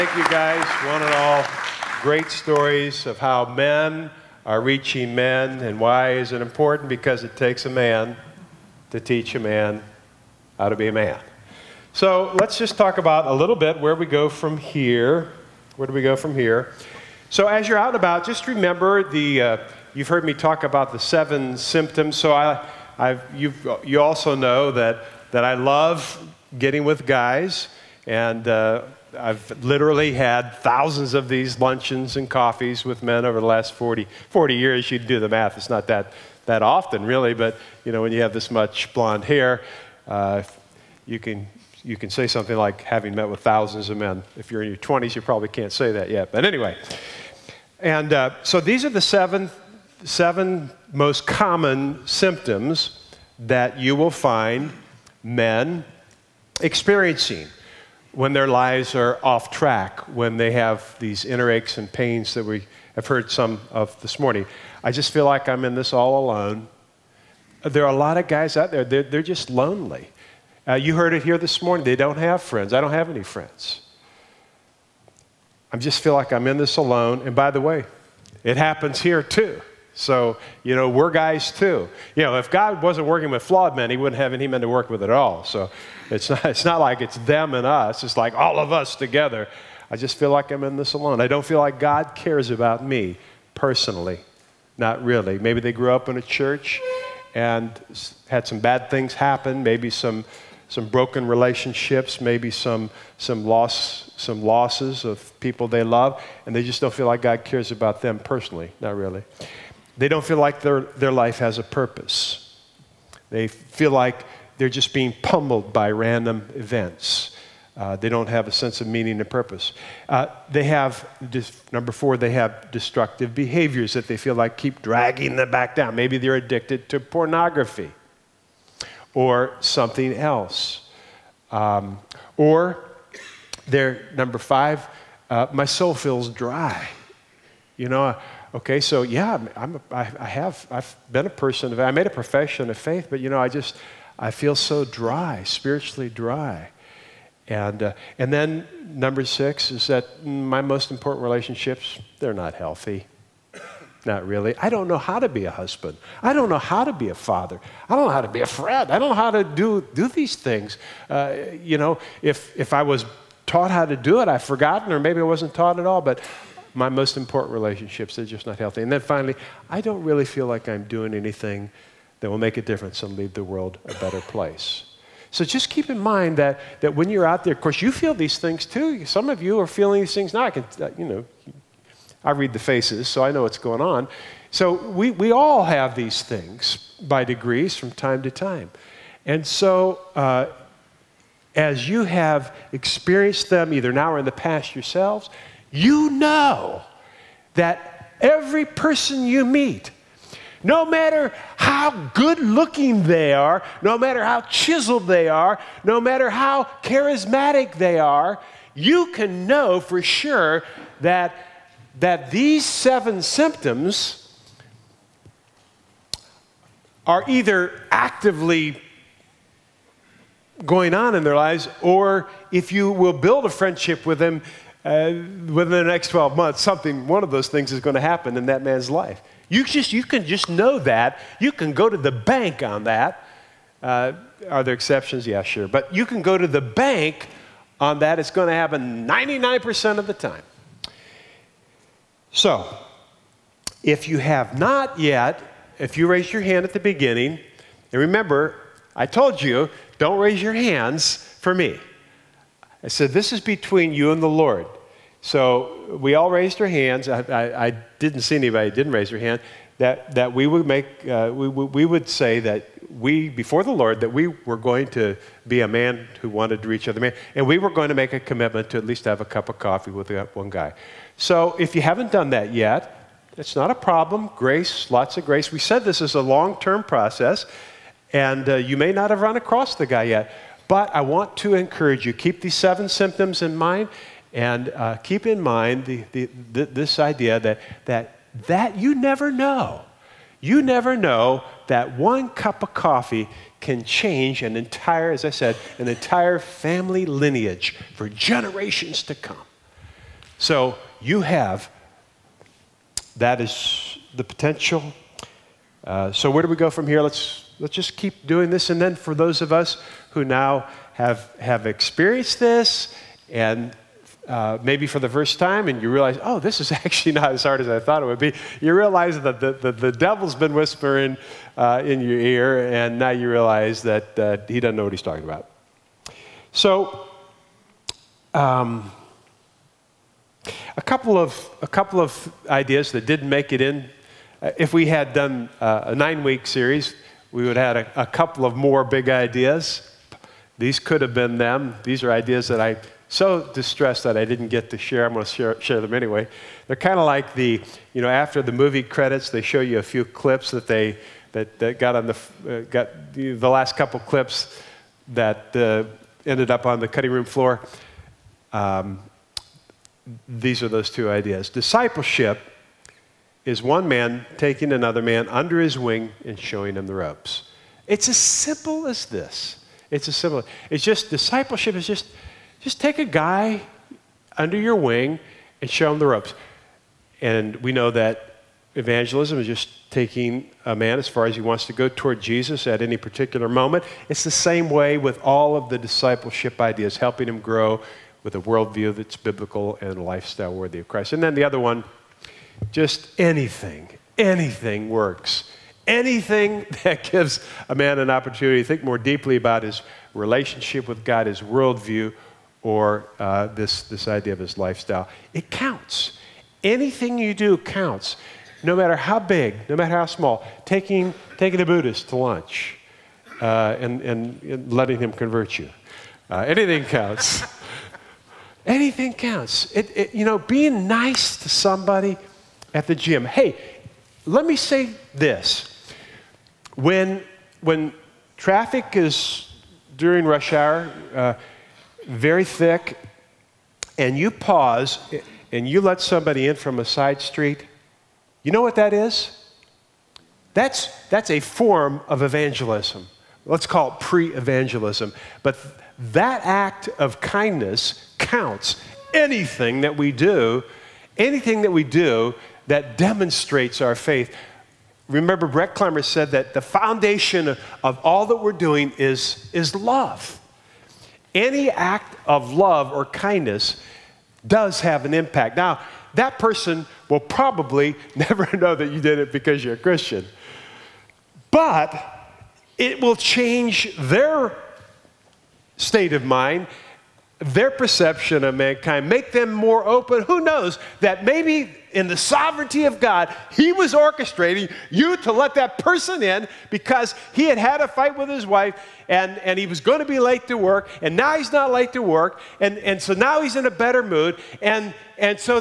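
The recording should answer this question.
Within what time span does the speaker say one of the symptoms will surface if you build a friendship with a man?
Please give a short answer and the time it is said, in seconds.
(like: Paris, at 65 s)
12 months, at 226 s.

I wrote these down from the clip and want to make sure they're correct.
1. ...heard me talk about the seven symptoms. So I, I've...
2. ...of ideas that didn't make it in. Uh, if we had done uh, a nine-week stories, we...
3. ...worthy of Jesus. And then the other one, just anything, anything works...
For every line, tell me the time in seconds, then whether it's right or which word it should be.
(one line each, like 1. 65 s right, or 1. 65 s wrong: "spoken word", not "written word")
1. 20 s right
2. 331 s wrong: "series", not "stories"
3. 390 s wrong: "Christ", not "Jesus".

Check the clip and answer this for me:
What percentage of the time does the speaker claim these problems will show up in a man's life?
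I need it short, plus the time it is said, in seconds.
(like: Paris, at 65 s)
99%, at 239 s.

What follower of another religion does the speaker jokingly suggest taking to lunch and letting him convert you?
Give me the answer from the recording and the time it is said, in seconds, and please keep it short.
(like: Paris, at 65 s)
a Buddhist, at 411 s.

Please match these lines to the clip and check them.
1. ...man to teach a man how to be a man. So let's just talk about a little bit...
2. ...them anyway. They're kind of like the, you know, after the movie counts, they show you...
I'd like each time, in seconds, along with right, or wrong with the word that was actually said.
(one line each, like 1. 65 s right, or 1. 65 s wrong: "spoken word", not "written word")
1. 7 s right
2. 345 s wrong: "credits", not "counts".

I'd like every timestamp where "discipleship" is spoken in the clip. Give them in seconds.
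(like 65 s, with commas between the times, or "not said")
361 s, 371 s, 385 s.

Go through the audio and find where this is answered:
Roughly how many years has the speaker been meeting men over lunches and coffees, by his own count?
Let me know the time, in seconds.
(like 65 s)
34 s.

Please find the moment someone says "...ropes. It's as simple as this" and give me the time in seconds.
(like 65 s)
366 s.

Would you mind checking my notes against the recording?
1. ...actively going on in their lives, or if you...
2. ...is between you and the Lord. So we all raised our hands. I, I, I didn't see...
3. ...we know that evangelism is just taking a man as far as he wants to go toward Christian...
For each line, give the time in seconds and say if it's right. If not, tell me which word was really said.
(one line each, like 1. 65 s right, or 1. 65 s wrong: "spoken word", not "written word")
1. 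217 s right
2. 253 s right
3. 377 s wrong: "Jesus", not "Christian".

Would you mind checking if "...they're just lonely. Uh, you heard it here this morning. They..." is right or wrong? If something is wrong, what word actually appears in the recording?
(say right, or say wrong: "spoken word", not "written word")
right.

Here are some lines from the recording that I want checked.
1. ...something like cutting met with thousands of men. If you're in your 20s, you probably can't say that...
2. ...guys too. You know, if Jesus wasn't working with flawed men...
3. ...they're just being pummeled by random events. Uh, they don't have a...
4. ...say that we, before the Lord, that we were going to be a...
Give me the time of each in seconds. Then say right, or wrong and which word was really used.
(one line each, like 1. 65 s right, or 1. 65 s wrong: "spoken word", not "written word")
1. 42 s wrong: "having", not "cutting"
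2. 81 s wrong: "God", not "Jesus"
3. 114 s right
4. 262 s right.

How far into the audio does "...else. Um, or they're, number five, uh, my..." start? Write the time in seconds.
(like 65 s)
130 s.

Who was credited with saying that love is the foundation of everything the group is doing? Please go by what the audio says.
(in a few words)
Brett Clemmer.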